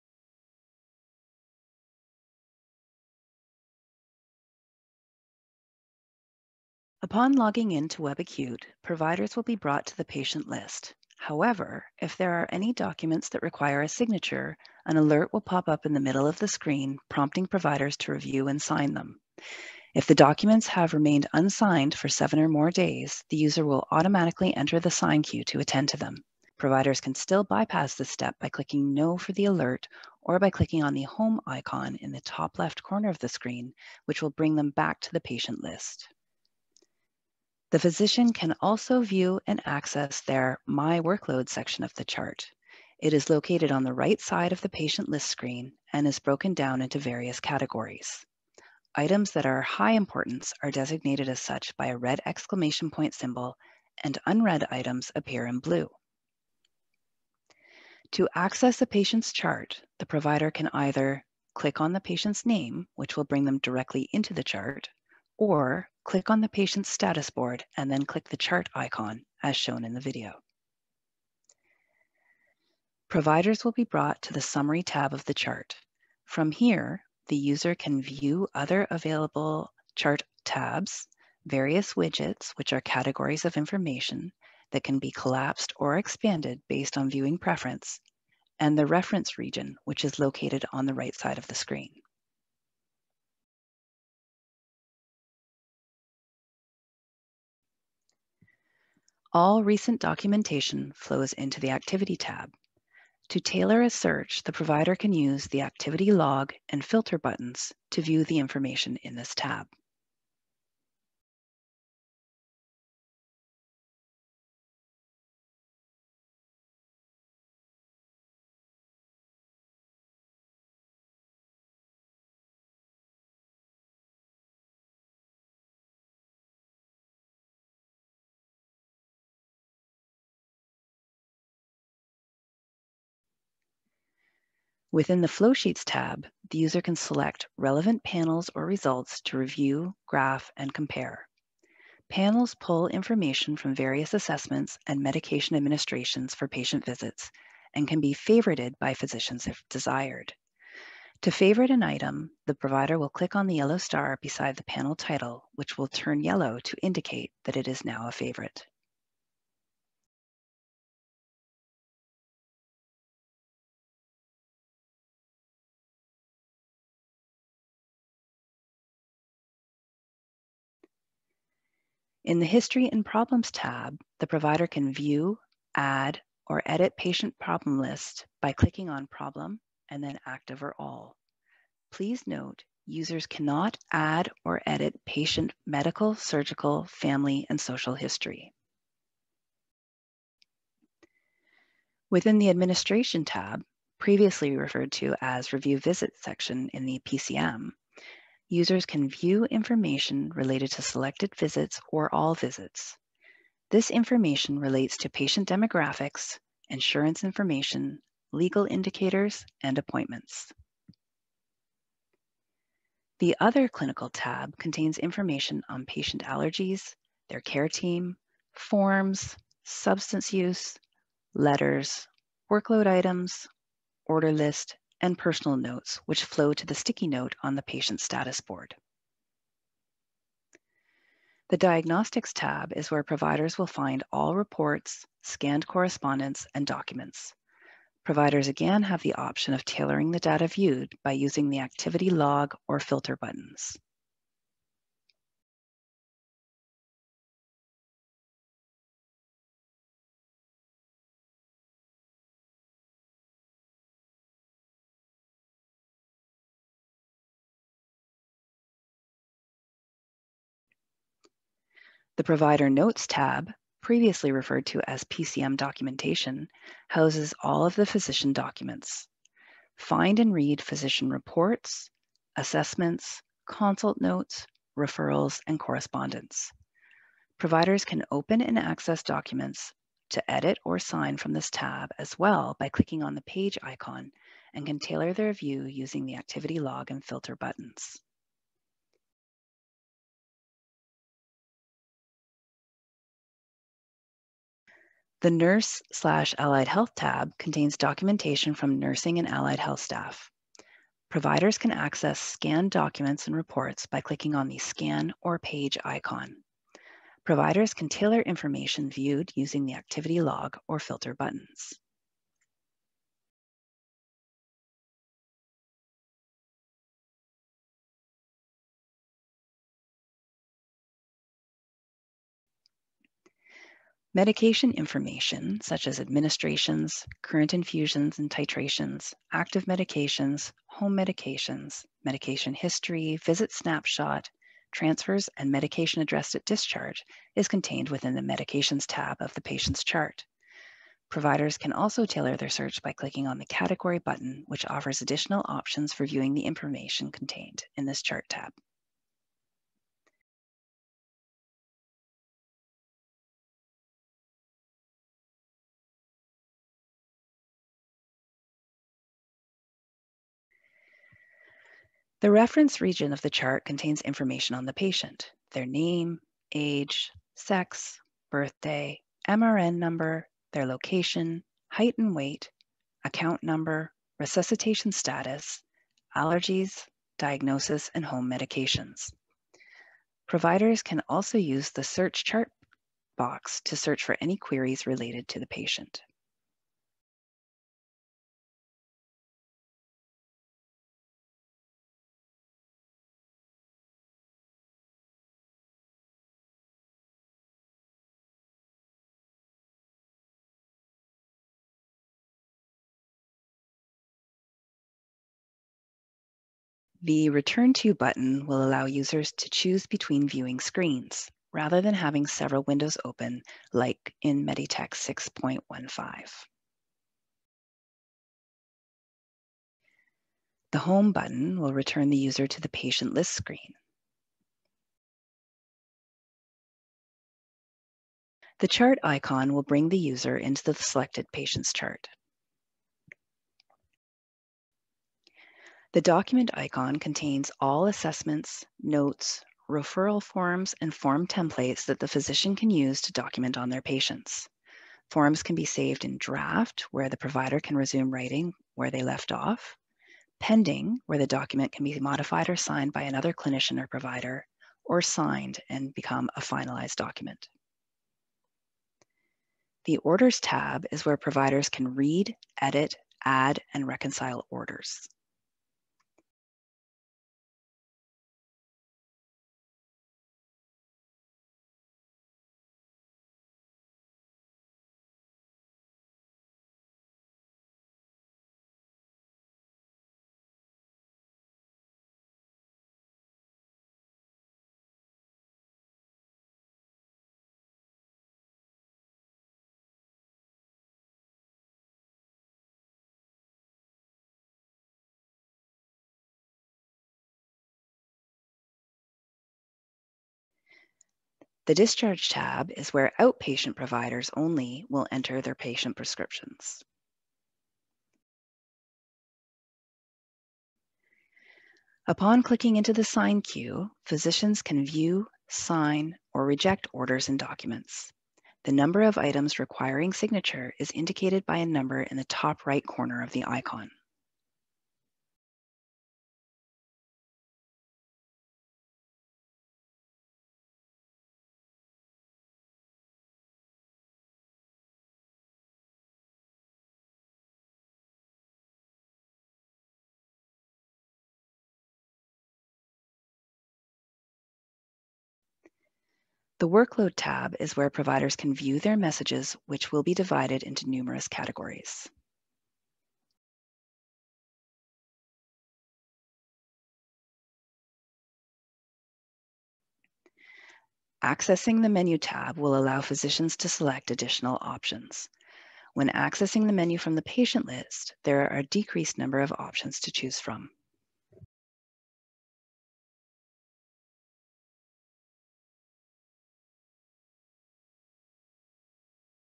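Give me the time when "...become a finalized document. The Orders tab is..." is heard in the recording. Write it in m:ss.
7:35.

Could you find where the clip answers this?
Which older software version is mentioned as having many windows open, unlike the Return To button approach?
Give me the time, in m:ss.
6:54.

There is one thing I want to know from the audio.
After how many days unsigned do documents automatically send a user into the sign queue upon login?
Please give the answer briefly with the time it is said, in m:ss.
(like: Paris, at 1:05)
7, at 0:22.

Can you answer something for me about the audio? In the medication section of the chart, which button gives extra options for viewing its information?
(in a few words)
Category.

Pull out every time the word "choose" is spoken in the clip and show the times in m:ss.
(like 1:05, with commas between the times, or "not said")
6:49, 9:30.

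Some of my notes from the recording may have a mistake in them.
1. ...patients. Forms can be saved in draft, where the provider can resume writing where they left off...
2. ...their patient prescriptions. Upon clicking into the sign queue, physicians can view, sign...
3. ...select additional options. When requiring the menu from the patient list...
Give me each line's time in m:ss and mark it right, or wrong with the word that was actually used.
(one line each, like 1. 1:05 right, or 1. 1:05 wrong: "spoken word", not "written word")
1. 7:23 right
2. 8:25 right
3. 9:23 wrong: "accessing", not "requiring".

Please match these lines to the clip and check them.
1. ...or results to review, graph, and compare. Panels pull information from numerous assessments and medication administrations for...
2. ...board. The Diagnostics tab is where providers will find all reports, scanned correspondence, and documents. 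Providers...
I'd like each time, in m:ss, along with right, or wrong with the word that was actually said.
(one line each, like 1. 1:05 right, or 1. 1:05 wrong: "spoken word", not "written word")
1. 2:18 wrong: "various", not "numerous"
2. 3:48 right.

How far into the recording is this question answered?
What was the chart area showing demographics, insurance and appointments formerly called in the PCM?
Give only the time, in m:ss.
3:15.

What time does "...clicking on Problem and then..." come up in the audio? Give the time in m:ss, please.
2:58.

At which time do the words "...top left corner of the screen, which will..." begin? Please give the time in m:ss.
0:32.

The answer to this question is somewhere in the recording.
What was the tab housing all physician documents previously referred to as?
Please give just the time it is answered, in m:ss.
4:25.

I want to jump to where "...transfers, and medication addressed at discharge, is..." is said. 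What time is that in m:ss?
5:34.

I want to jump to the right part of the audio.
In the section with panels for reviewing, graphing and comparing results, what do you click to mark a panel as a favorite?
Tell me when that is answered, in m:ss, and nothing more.
2:33.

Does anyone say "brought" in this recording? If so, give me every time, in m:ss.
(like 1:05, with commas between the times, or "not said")
0:09, 1:13.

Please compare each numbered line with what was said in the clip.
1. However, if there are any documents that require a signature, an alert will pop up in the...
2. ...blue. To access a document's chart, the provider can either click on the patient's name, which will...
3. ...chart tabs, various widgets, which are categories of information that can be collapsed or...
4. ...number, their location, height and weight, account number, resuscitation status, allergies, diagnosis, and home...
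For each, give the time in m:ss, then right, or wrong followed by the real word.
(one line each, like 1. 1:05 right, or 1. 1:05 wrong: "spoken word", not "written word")
1. 0:11 right
2. 0:55 wrong: "patient", not "document"
3. 1:19 right
4. 6:09 right.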